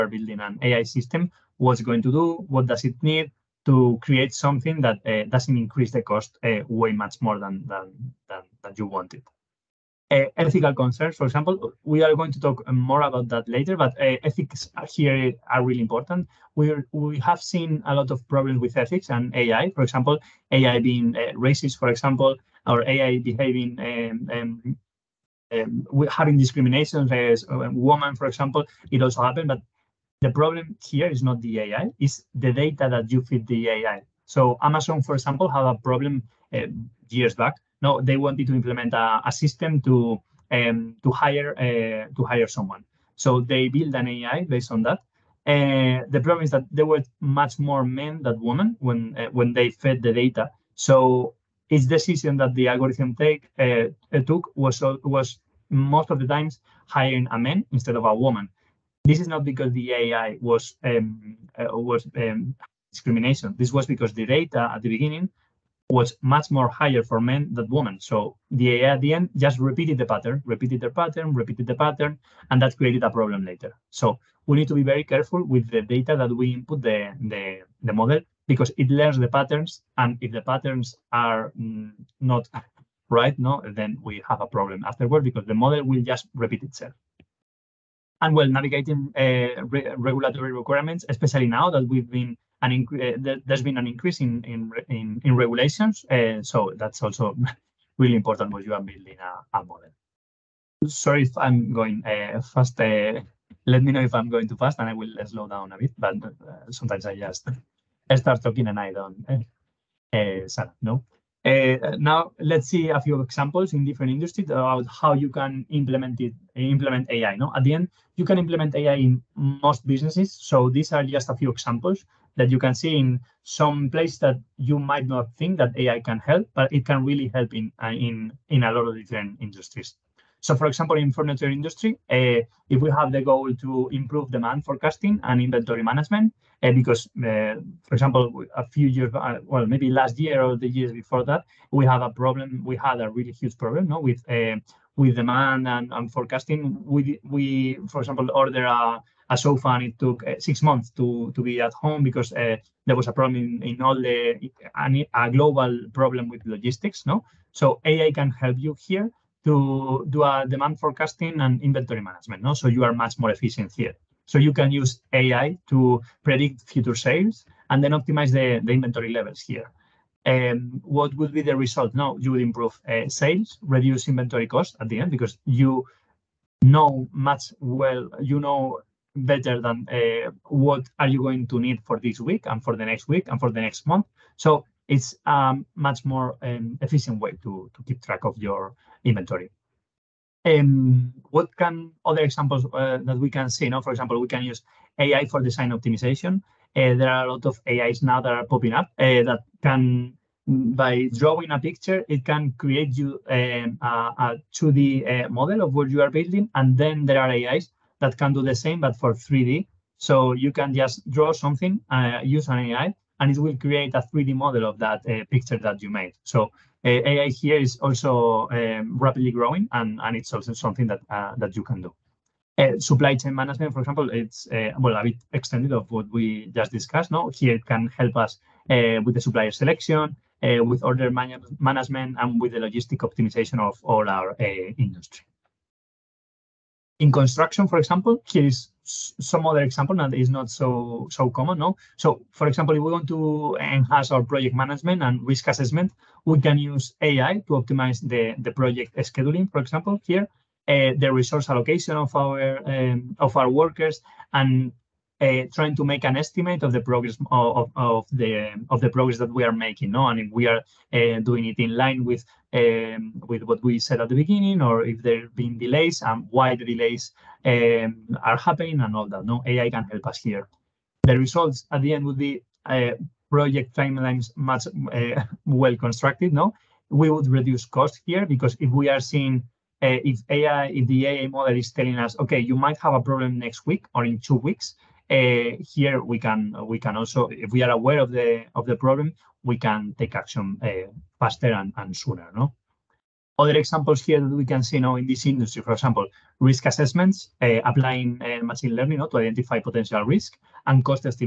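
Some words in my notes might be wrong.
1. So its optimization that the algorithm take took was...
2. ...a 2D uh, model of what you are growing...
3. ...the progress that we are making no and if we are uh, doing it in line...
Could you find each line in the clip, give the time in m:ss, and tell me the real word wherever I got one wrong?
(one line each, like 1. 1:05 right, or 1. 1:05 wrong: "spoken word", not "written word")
1. 0:50 wrong: "decision", not "optimization"
2. 3:23 wrong: "building", not "growing"
3. 4:18 right.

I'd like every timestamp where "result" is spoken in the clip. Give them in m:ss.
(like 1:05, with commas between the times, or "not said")
2:51, 4:31.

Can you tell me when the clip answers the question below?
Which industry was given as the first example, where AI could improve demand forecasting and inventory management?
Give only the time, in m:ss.
2:11.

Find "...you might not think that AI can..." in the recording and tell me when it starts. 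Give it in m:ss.
2:04.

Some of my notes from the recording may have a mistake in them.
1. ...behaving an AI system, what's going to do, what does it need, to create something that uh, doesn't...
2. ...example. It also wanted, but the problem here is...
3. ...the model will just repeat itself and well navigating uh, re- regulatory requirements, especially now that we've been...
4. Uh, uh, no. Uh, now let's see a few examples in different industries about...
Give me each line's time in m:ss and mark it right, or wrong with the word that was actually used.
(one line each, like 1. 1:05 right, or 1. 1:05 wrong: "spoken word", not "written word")
1. 0:00 wrong: "building", not "behaving"
2. 0:28 wrong: "happened", not "wanted"
3. 1:25 right
4. 1:50 right.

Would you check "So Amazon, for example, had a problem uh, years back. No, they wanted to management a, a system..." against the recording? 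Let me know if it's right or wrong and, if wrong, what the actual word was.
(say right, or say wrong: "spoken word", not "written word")
wrong: "implement", not "management".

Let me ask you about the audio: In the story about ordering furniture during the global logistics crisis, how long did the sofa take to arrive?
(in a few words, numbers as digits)
6 months.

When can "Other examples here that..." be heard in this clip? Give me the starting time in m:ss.
4:53.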